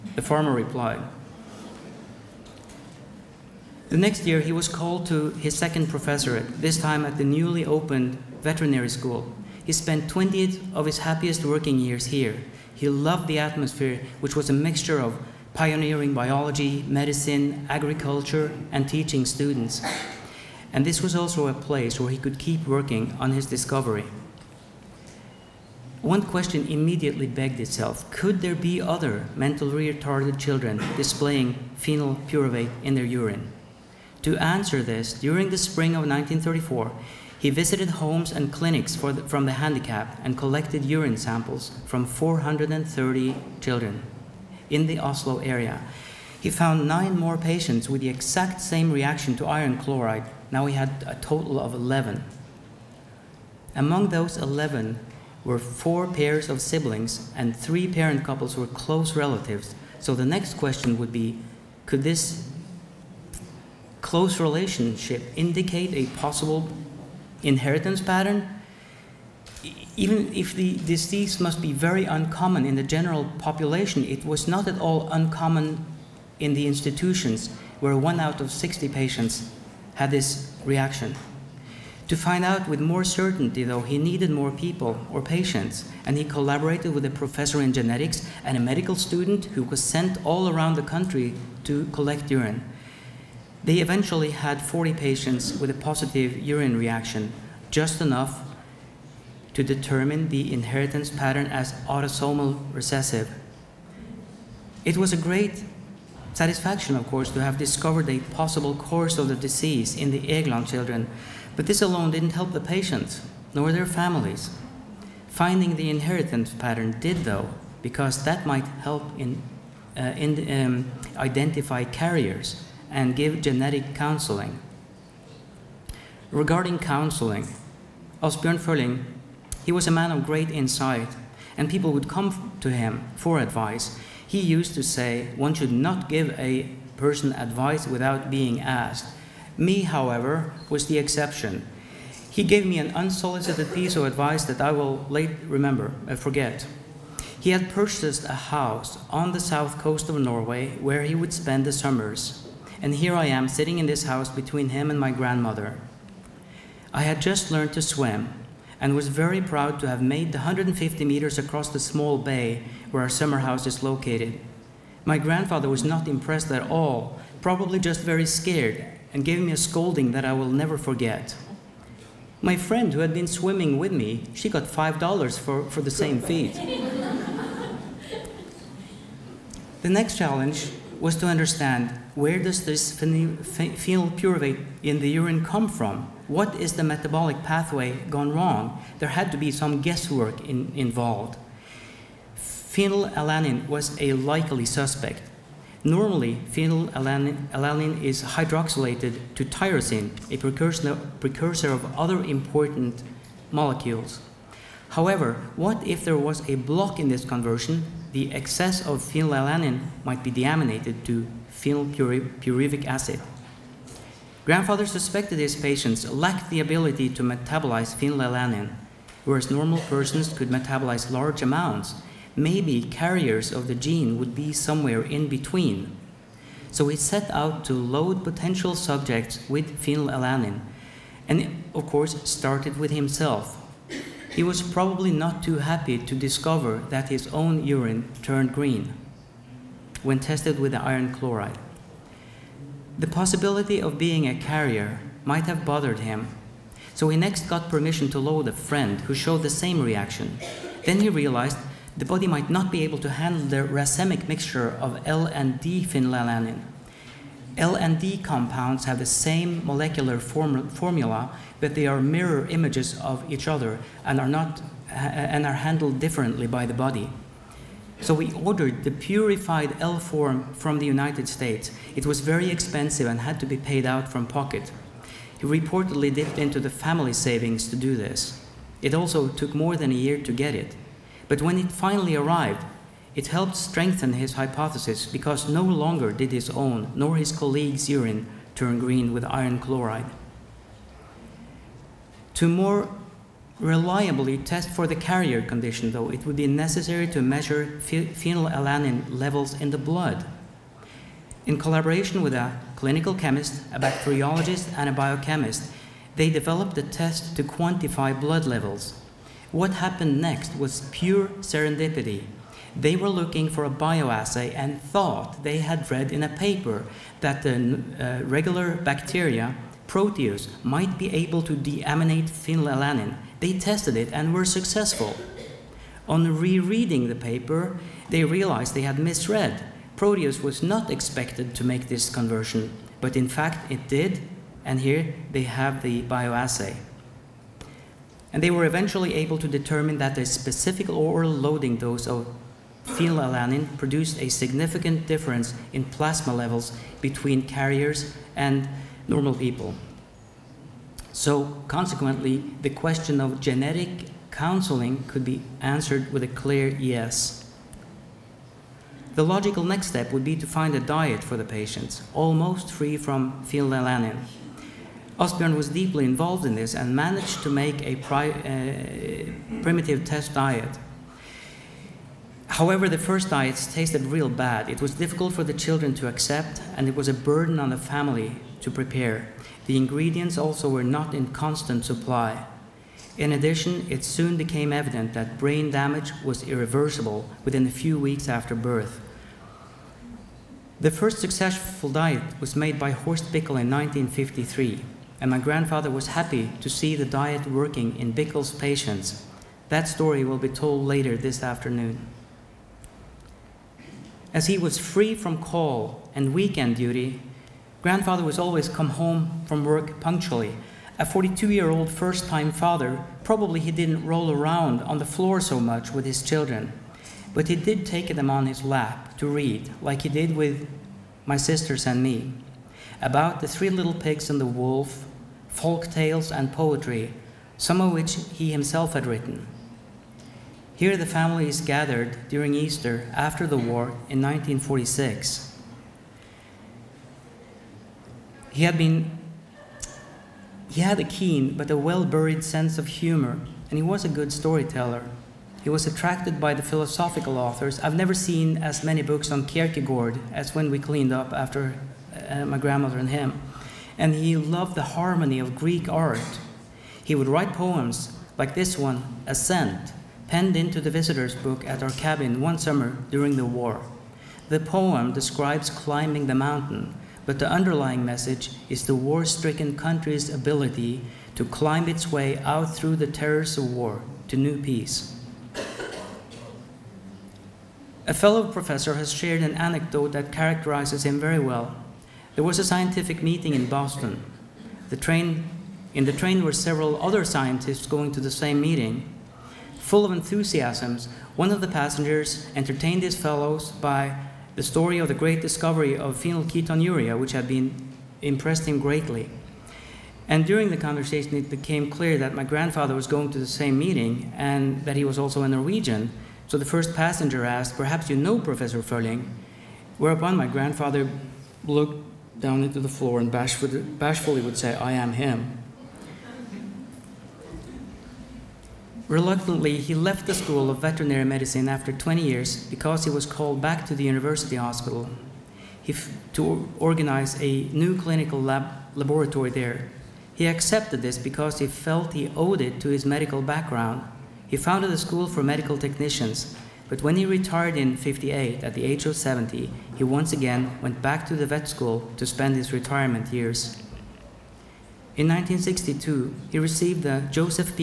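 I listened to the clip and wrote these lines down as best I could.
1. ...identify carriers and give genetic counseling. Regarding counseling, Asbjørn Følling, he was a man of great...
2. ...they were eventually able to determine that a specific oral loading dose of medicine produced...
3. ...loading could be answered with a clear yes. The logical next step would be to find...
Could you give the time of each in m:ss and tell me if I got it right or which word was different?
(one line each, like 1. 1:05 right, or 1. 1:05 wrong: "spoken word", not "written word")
1. 2:01 right
2. 5:38 wrong: "phenylalanine", not "medicine"
3. 5:54 wrong: "counseling", not "loading".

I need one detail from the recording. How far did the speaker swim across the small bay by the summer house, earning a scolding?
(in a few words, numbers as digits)
150 meters.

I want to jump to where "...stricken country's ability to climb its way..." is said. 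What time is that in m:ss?
7:49.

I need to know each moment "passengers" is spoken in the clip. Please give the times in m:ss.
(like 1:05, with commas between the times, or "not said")
8:11, 8:26.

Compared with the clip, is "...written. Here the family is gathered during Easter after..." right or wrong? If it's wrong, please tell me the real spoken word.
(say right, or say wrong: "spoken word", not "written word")
right.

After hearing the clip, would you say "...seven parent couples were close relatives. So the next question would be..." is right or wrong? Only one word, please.
wrong.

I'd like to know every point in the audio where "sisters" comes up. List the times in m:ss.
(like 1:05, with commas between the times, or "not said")
7:01.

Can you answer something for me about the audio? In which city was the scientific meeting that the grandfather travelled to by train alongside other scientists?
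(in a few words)
Boston.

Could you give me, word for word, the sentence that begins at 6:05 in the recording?
Asbjørn was deeply involved in this and managed to make a pri uh, primitive test diet.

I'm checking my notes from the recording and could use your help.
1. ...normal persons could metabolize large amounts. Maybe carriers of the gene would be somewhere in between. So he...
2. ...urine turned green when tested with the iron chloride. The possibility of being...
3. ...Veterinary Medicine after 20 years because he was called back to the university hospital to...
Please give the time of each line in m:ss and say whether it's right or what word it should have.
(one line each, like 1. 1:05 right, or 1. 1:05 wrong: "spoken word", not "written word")
1. 3:39 right
2. 3:57 right
3. 8:40 right.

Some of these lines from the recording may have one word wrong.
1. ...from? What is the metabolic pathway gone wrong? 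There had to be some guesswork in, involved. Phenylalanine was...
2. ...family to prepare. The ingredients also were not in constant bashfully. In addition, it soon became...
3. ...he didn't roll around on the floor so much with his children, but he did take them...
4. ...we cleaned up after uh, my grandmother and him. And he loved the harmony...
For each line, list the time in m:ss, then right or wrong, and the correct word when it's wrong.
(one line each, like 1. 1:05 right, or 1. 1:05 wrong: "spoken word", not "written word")
1. 3:05 right
2. 6:17 wrong: "supply", not "bashfully"
3. 6:53 right
4. 7:30 right.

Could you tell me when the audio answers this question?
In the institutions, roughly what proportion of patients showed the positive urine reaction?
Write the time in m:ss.
1:17.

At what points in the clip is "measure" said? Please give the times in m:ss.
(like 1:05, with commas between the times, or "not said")
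4:57.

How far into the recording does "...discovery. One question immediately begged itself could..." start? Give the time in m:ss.
0:23.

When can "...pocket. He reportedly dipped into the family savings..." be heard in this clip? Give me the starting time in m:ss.
4:34.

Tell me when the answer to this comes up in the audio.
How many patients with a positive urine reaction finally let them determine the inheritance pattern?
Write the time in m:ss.
1:34.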